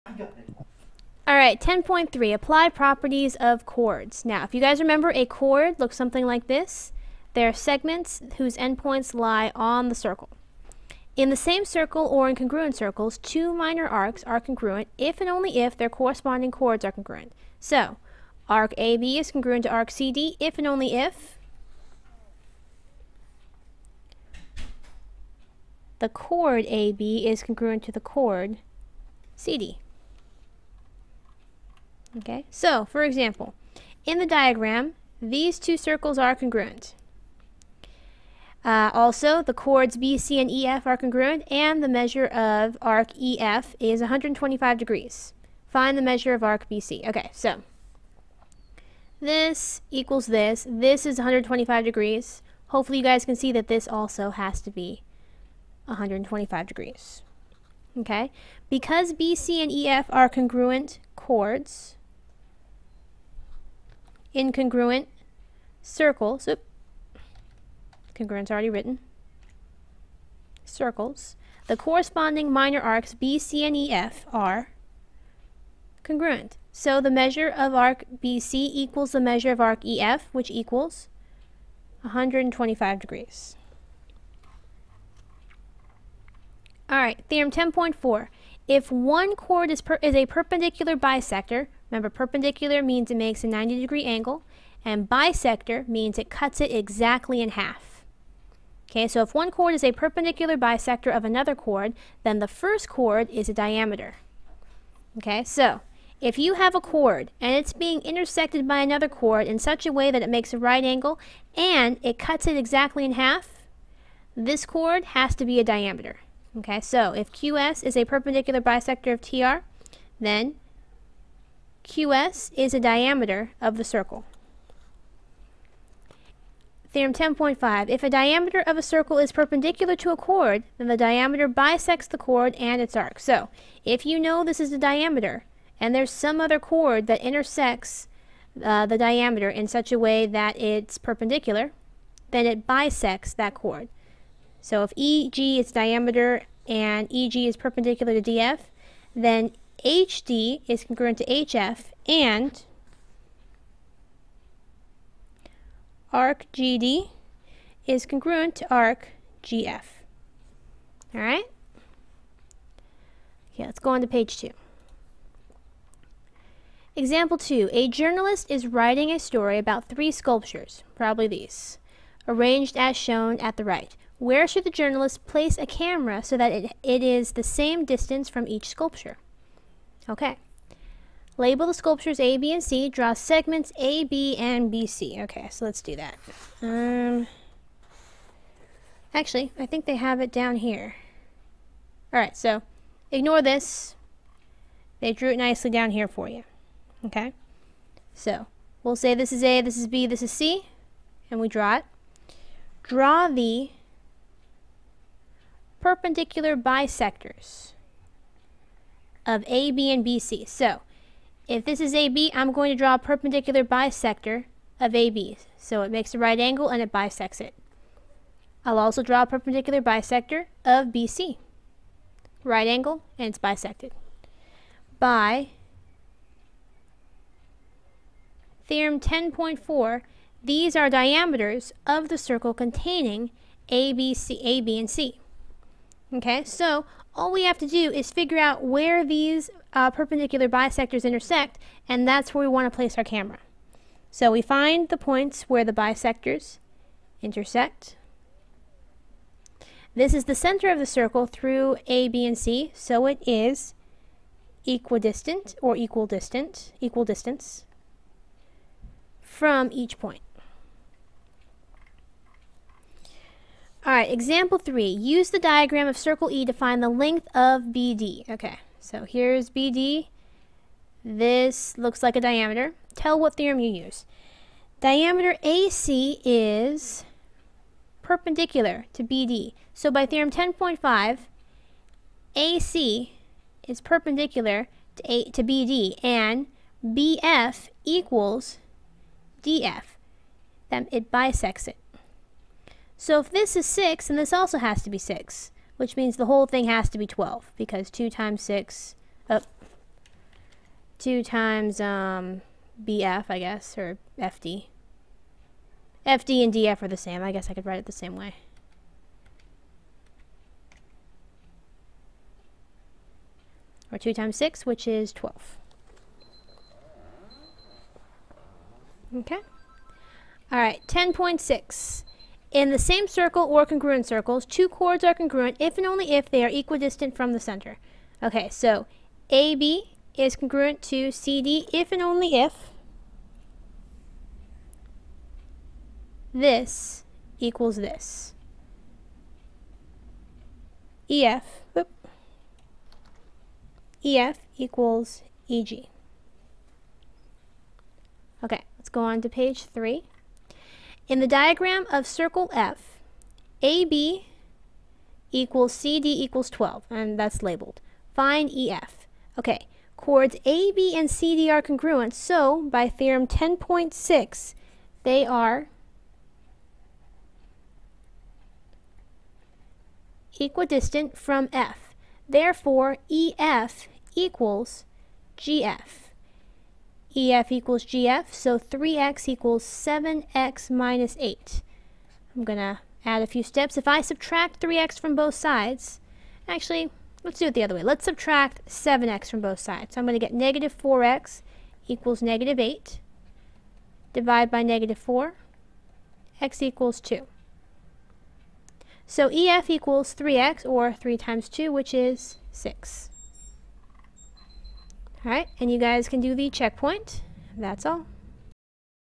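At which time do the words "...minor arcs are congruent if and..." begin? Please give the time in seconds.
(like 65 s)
13 s.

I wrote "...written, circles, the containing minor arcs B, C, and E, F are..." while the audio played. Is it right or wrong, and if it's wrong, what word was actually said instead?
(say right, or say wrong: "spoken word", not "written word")
wrong: "corresponding", not "containing".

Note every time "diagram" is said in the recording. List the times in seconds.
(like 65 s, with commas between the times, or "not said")
34 s, 265 s, 351 s.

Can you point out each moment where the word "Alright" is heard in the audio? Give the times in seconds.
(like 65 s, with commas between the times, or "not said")
192 s, 263 s, 405 s.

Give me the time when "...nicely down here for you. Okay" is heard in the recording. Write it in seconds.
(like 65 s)
195 s.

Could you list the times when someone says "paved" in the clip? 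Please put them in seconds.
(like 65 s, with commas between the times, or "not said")
not said.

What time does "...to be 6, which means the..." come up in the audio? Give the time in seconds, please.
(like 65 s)
294 s.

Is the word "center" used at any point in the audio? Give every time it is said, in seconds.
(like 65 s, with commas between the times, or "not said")
250 s, 327 s.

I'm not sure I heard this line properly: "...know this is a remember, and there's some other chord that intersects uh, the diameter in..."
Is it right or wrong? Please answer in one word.
wrong.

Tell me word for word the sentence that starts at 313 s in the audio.
Or 2 times 6, which is 12.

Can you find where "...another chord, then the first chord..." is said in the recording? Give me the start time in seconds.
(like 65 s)
101 s.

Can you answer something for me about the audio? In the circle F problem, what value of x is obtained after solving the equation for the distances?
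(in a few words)
2.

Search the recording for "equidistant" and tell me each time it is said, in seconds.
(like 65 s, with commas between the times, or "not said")
254 s, 326 s, 370 s.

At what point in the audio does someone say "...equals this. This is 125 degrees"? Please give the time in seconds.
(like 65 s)
49 s.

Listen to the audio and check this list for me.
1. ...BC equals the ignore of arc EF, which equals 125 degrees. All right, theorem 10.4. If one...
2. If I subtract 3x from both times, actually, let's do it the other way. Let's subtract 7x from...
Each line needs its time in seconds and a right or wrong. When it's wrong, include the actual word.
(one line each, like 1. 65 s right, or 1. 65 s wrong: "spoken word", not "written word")
1. 78 s wrong: "measure", not "ignore"
2. 383 s wrong: "sides", not "times".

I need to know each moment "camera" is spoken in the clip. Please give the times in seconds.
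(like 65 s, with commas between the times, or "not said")
175 s, 243 s.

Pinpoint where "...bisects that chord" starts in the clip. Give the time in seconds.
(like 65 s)
142 s.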